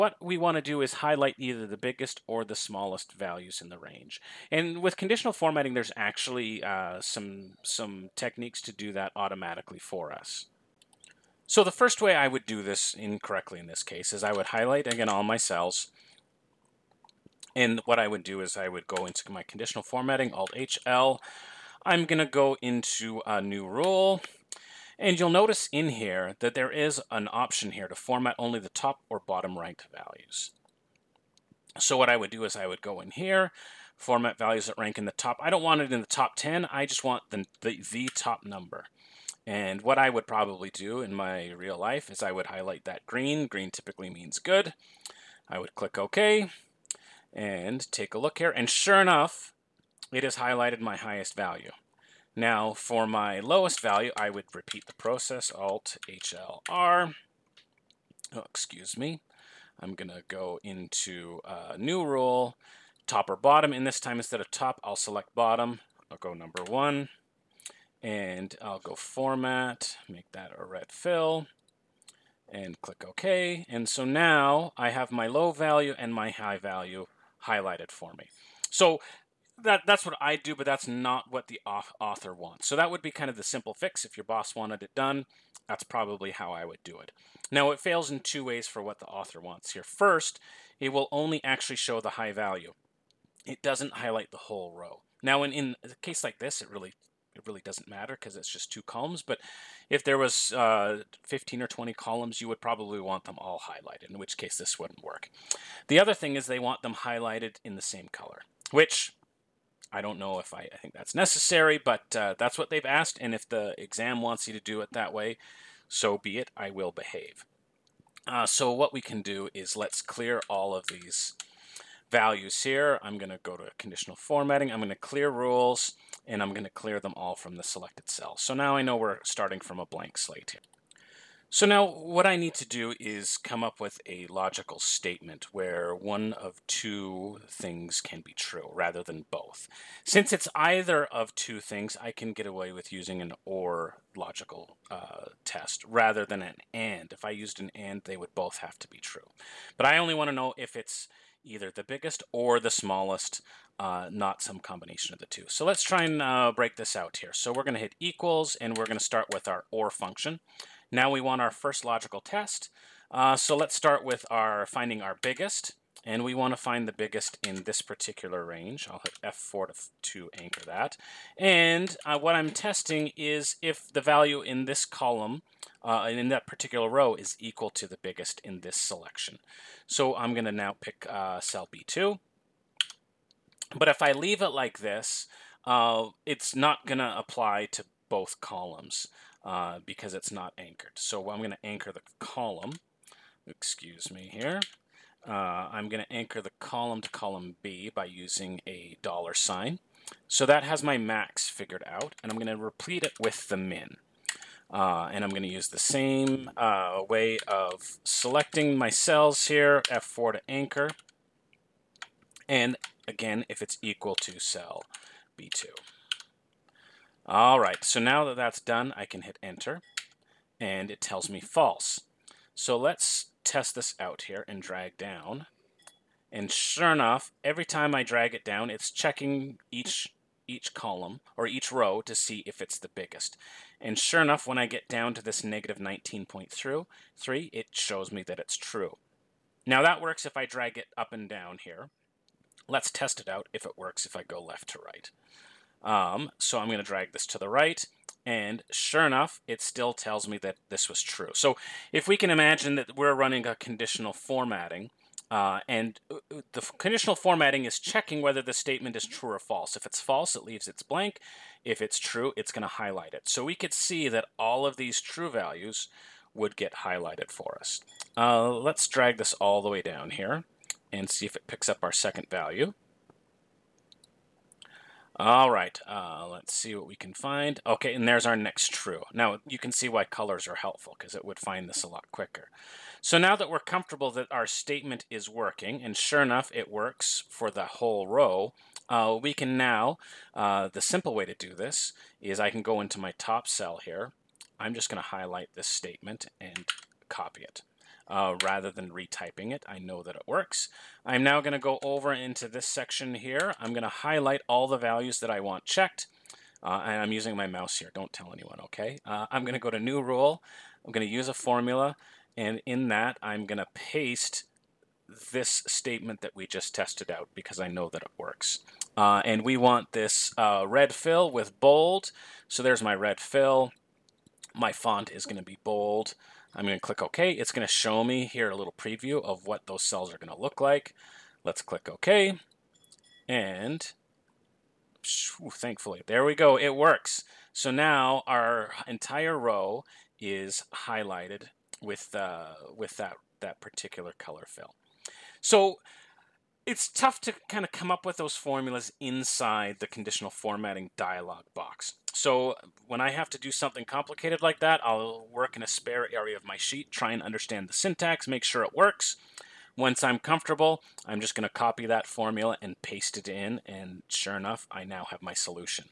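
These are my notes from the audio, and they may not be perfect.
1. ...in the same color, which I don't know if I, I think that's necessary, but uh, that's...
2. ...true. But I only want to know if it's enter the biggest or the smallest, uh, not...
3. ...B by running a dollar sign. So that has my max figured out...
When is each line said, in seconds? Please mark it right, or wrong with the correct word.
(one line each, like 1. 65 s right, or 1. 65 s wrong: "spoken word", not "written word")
1. 107 s right
2. 148 s wrong: "either", not "enter"
3. 197 s wrong: "using", not "running".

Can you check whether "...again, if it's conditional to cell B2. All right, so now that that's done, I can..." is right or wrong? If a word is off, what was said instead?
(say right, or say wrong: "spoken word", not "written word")
wrong: "equal", not "conditional".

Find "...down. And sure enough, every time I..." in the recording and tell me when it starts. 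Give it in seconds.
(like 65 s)
224 s.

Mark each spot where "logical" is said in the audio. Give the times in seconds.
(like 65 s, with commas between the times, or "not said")
134 s, 144 s, 161 s.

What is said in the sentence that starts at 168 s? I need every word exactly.
I'll hit F4 to, to anchor that.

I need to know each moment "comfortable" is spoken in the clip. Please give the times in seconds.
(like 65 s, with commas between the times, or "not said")
283 s, 360 s.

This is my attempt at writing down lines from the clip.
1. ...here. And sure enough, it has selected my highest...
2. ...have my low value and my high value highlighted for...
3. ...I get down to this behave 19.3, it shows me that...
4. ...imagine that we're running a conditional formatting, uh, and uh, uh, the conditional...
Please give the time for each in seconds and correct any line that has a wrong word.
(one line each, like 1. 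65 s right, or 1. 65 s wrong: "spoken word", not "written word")
1. 48 s wrong: "highlighted", not "selected"
2. 74 s right
3. 234 s wrong: "negative", not "behave"
4. 252 s right.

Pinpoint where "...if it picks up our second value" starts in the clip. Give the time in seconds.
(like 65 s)
271 s.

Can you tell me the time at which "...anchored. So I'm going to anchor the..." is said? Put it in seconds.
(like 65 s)
190 s.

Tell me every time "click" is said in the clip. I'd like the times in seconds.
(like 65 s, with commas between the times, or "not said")
45 s, 72 s, 326 s, 331 s.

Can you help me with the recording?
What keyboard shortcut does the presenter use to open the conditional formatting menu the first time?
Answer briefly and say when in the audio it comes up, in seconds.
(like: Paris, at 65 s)
Alt-HL, at 20 s.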